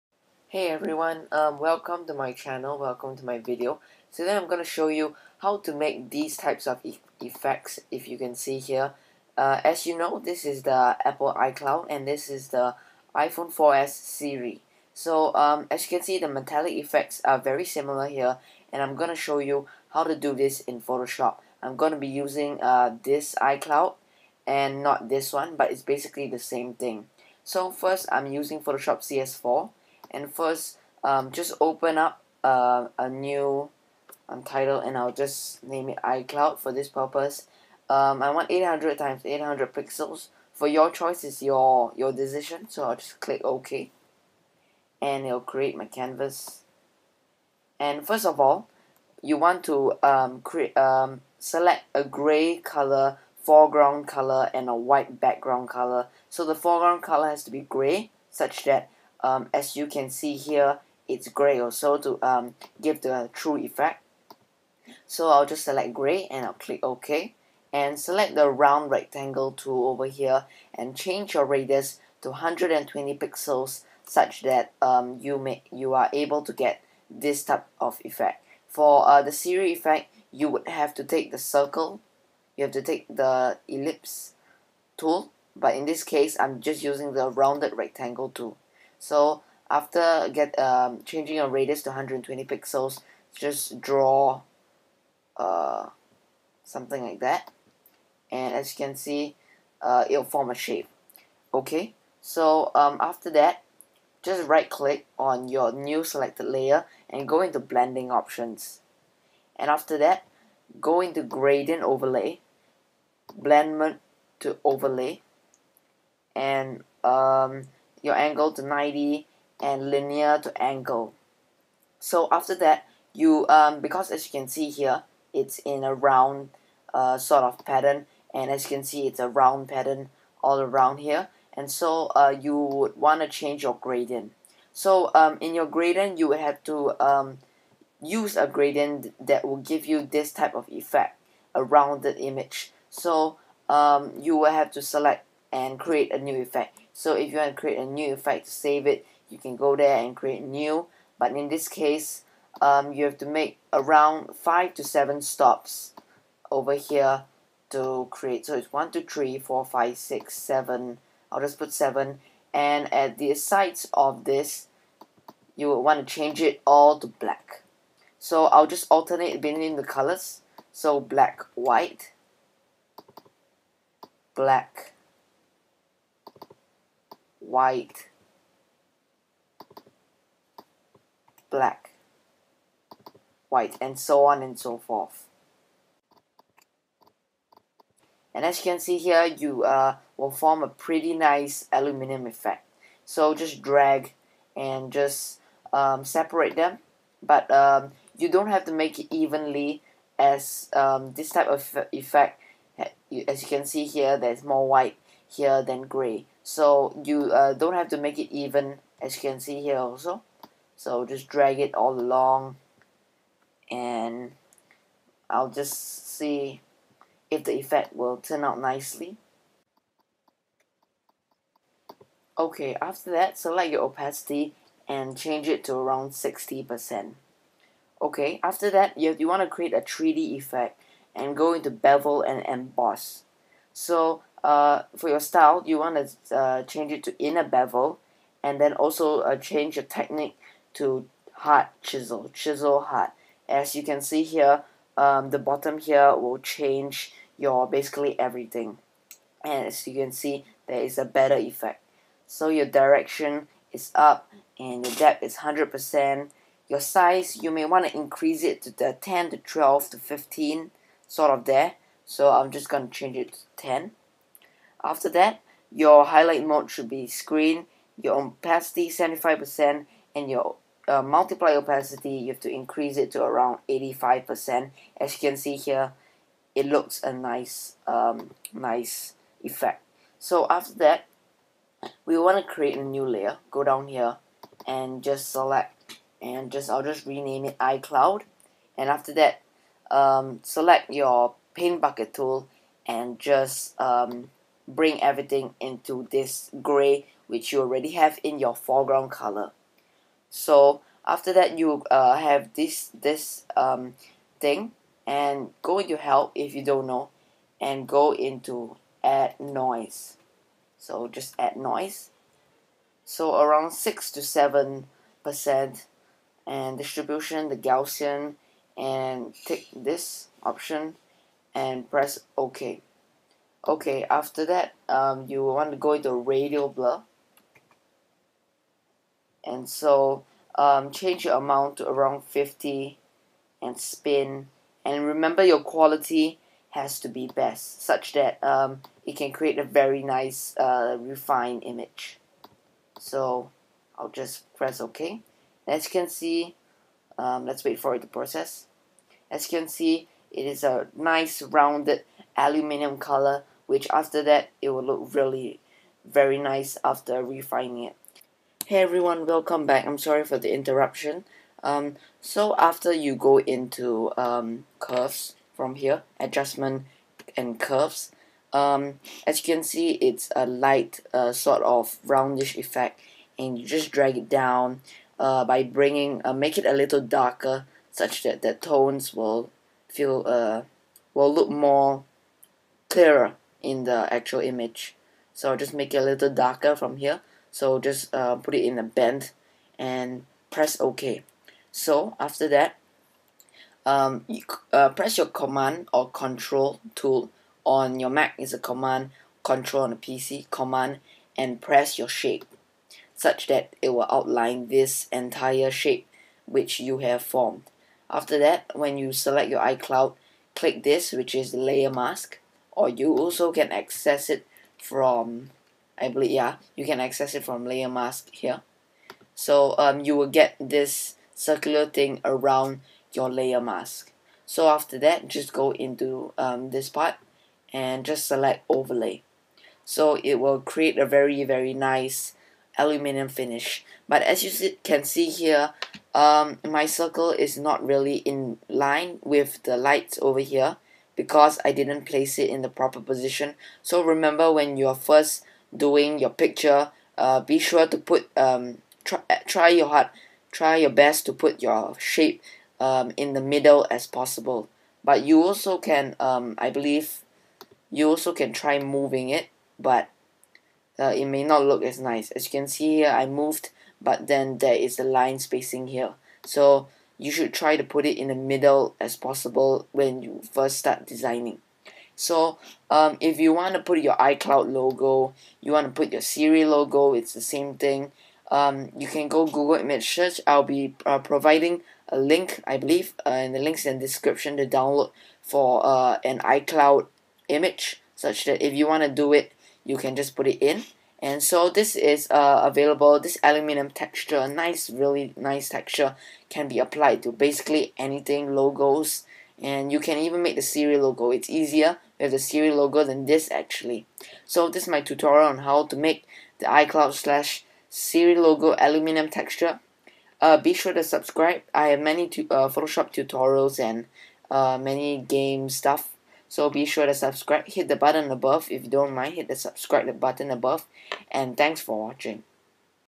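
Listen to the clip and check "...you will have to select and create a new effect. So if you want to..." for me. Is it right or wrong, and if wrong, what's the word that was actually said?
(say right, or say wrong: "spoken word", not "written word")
right.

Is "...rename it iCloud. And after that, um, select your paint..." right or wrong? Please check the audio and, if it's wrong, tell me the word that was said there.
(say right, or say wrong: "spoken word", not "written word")
right.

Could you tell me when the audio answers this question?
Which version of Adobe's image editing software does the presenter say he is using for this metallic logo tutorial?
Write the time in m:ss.
0:28.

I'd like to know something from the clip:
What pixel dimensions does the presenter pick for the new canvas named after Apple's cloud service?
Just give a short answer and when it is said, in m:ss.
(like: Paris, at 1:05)
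800 times 800 pixels, at 0:38.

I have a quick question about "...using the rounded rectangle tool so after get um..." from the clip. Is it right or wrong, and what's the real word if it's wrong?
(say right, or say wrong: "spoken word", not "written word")
right.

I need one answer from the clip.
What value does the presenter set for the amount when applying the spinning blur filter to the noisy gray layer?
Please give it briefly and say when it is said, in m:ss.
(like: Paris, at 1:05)
50, at 5:32.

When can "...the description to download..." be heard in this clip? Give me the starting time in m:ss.
8:03.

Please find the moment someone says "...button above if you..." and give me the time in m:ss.
8:37.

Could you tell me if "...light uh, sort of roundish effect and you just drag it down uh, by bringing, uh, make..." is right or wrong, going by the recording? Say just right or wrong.
right.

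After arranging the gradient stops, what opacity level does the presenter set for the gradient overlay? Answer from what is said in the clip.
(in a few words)
60%.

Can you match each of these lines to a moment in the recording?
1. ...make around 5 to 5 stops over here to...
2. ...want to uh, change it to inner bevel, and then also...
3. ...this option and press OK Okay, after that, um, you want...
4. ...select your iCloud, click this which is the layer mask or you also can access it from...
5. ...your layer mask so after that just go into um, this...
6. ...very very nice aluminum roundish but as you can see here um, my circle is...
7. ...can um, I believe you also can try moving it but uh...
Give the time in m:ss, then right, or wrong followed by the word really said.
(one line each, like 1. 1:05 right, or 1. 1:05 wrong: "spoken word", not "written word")
1. 2:33 wrong: "7", not "5"
2. 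3:55 right
3. 5:19 right
4. 6:49 right
5. 7:03 right
6. 7:11 wrong: "finish", not "roundish"
7. 7:35 right.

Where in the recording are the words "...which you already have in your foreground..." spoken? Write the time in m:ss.
4:57.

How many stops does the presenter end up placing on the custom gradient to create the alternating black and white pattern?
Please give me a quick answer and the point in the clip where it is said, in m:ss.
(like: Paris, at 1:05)
7, at 2:41.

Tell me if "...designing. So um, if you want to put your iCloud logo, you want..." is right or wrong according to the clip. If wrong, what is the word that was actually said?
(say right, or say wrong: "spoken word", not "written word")
right.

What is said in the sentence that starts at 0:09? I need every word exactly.
Uh, as you know, this is the Apple iCloud and this is the iPhone 4S Siri.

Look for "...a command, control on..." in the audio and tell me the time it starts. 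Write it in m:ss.
6:38.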